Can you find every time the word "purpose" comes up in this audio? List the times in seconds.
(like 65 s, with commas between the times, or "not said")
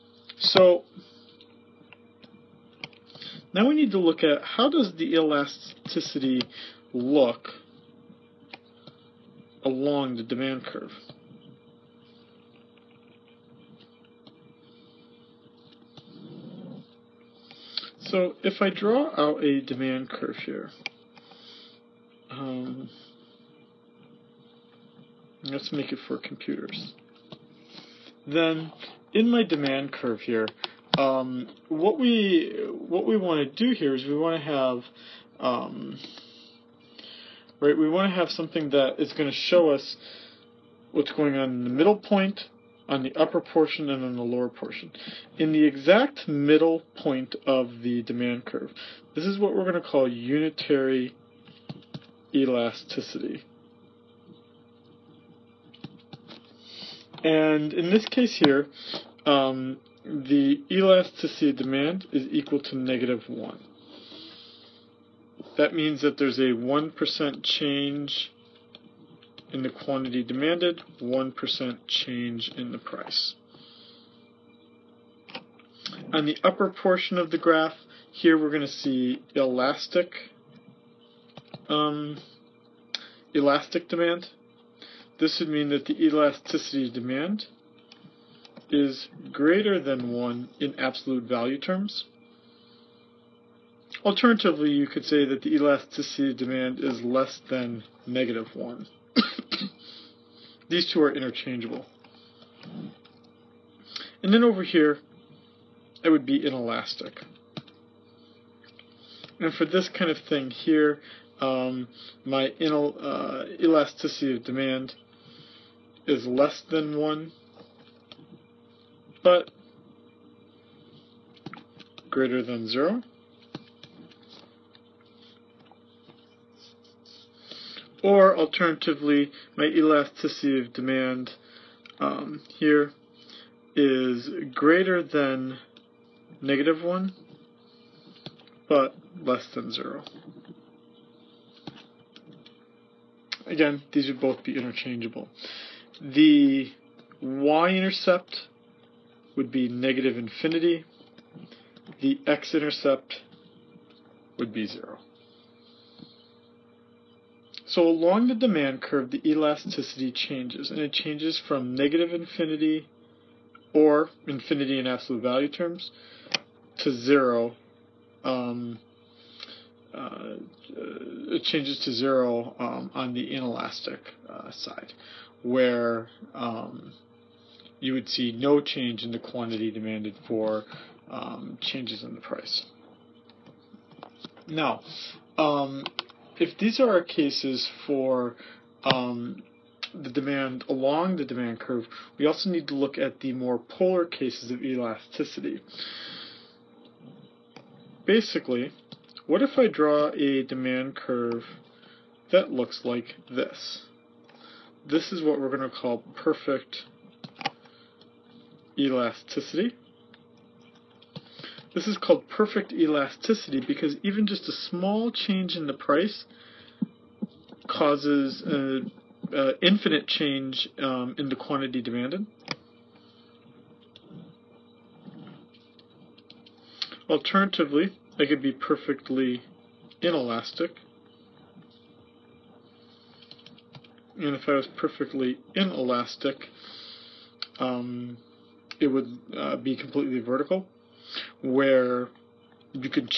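not said.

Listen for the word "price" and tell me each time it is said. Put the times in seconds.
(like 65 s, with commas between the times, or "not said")
72 s, 182 s, 215 s.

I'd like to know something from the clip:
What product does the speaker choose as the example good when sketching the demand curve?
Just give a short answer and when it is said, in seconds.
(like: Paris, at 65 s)
Computers, at 26 s.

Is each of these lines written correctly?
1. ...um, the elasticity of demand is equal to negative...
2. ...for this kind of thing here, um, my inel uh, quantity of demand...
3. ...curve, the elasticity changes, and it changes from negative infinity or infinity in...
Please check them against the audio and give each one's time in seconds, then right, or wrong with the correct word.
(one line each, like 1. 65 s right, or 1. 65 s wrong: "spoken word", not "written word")
1. 59 s right
2. 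109 s wrong: "elasticity", not "quantity"
3. 158 s right.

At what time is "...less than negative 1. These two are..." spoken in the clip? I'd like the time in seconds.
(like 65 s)
97 s.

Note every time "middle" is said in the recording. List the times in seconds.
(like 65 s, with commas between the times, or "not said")
41 s, 46 s.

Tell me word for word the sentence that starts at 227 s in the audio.
Alternatively, I could be perfectly inelastic.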